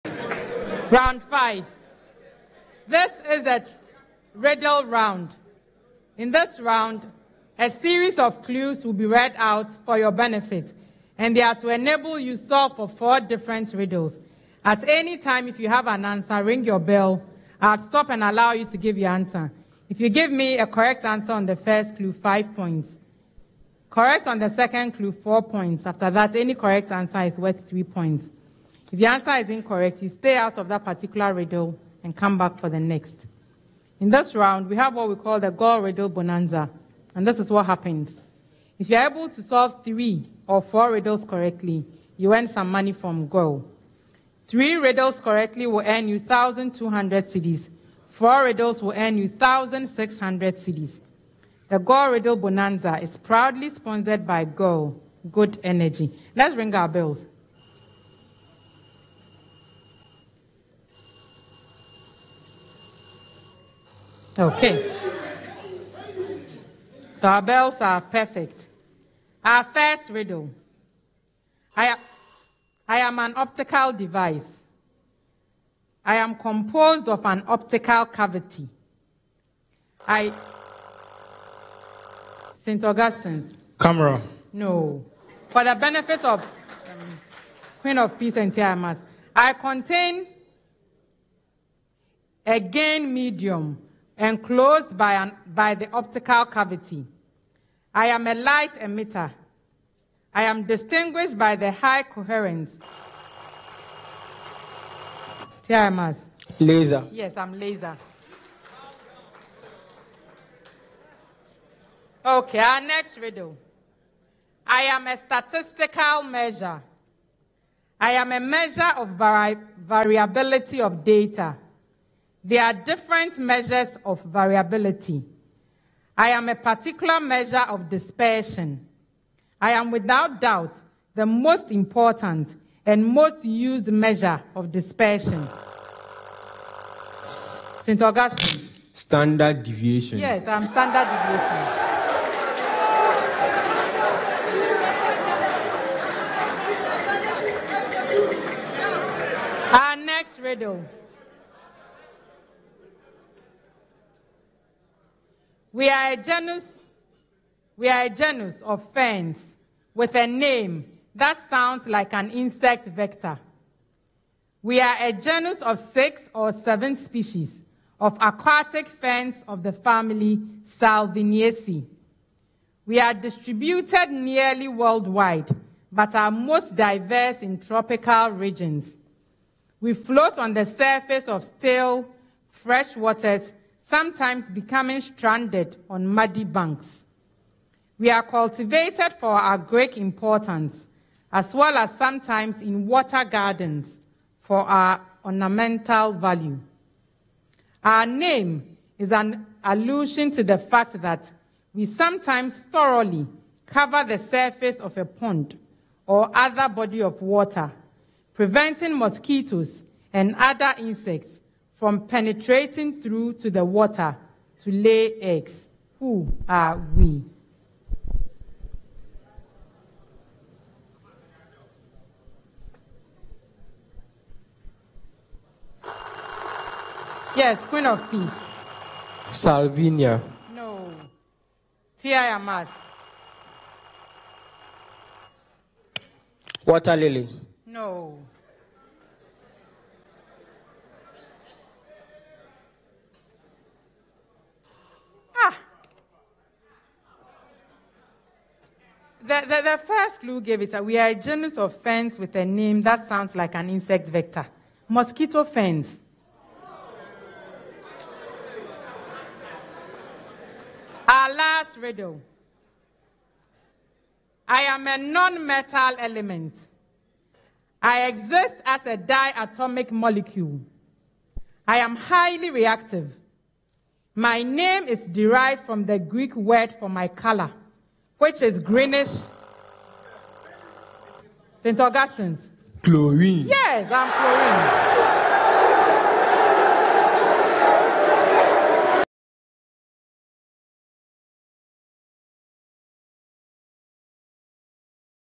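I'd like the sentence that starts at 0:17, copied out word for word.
I'll stop and allow you to give your answer.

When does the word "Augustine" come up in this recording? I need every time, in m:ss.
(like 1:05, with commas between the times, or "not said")
1:22, 2:18, 4:41.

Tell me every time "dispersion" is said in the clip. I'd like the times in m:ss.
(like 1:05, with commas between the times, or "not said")
2:07, 2:14.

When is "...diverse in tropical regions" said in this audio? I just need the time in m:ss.
2:56.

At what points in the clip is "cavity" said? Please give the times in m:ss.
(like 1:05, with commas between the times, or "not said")
1:18, 1:36.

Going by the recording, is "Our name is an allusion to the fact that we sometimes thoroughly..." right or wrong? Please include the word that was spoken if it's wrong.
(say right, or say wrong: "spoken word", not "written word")
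right.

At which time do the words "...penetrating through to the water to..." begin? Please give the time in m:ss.
3:32.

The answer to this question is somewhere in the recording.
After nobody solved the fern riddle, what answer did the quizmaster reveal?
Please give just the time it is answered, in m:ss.
4:14.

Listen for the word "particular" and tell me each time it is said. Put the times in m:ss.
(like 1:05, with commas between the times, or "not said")
0:30, 2:06.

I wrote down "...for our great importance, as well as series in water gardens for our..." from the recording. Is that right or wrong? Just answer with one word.
wrong.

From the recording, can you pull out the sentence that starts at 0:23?
Correct on the second clue, four points.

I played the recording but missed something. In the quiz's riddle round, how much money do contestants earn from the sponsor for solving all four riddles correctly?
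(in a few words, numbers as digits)
1,600 cedis.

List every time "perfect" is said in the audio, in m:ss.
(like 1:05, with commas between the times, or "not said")
1:08.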